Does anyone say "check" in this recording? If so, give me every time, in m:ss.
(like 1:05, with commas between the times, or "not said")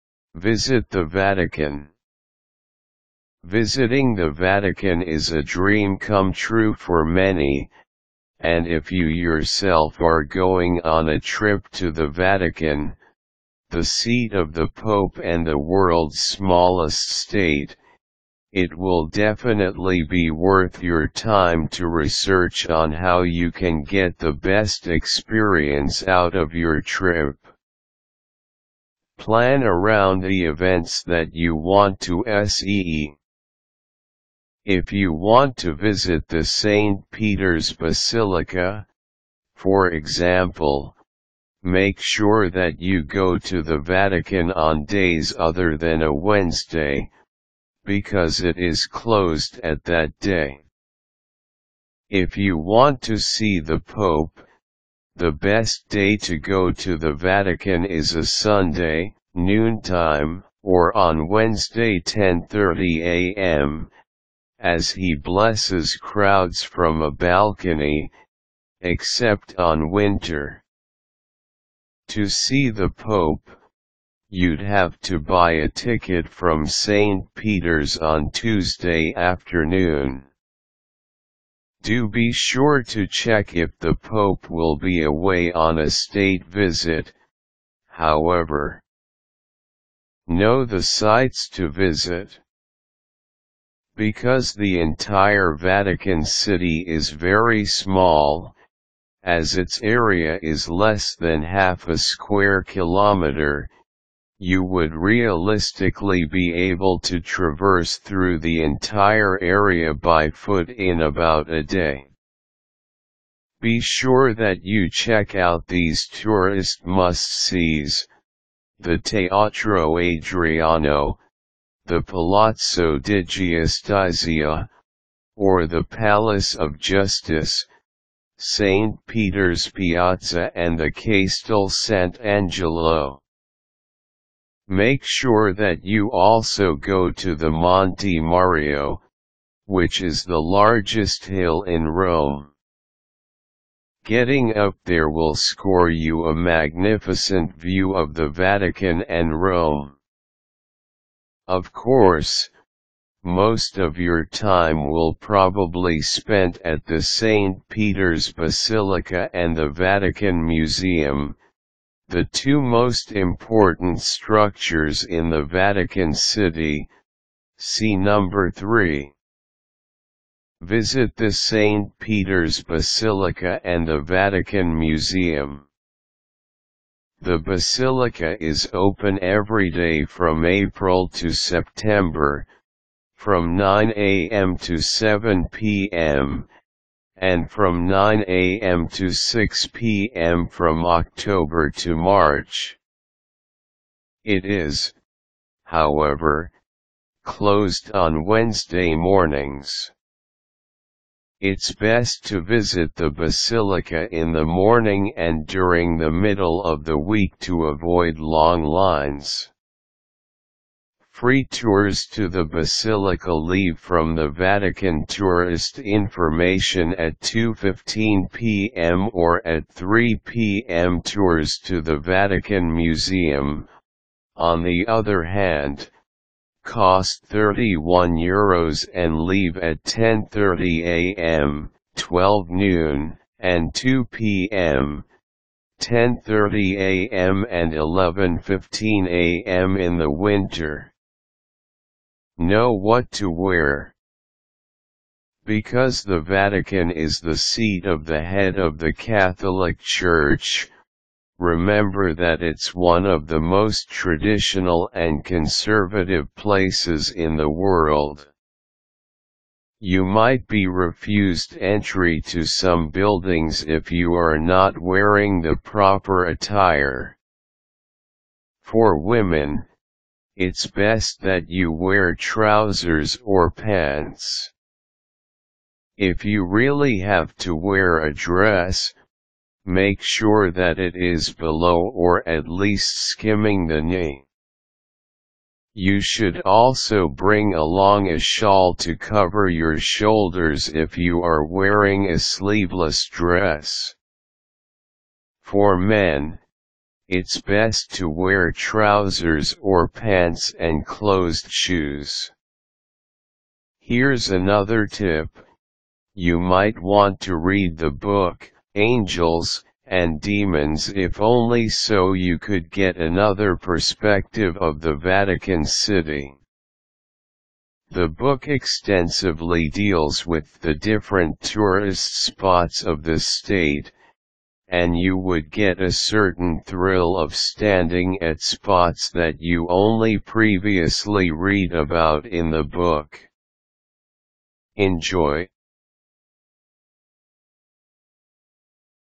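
1:23, 1:54.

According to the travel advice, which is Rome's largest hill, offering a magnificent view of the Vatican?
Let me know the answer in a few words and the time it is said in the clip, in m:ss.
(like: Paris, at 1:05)
Monte Mario, at 2:17.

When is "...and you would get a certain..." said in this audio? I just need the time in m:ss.
5:24.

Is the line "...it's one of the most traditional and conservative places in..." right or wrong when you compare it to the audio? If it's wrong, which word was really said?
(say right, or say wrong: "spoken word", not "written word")
right.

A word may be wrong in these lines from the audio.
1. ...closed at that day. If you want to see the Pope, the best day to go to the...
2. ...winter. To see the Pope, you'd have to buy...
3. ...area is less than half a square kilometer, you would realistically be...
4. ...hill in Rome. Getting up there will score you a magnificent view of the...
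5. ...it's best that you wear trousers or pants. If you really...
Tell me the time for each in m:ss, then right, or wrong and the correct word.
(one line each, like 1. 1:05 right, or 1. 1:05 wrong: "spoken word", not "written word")
1. 0:48 right
2. 1:09 right
3. 1:39 right
4. 2:21 right
5. 4:30 right.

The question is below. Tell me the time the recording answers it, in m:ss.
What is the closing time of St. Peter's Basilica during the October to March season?
3:09.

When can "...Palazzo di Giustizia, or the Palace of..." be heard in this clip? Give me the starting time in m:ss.
2:02.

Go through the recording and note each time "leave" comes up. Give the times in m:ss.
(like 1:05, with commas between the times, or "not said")
3:33, 3:49.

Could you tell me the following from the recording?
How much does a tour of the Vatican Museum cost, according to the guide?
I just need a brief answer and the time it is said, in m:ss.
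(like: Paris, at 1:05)
31 euros, at 3:47.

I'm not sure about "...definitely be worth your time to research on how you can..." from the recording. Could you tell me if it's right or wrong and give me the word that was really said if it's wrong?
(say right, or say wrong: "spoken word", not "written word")
right.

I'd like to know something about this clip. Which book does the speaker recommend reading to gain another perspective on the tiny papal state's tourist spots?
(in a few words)
Angels and Demons.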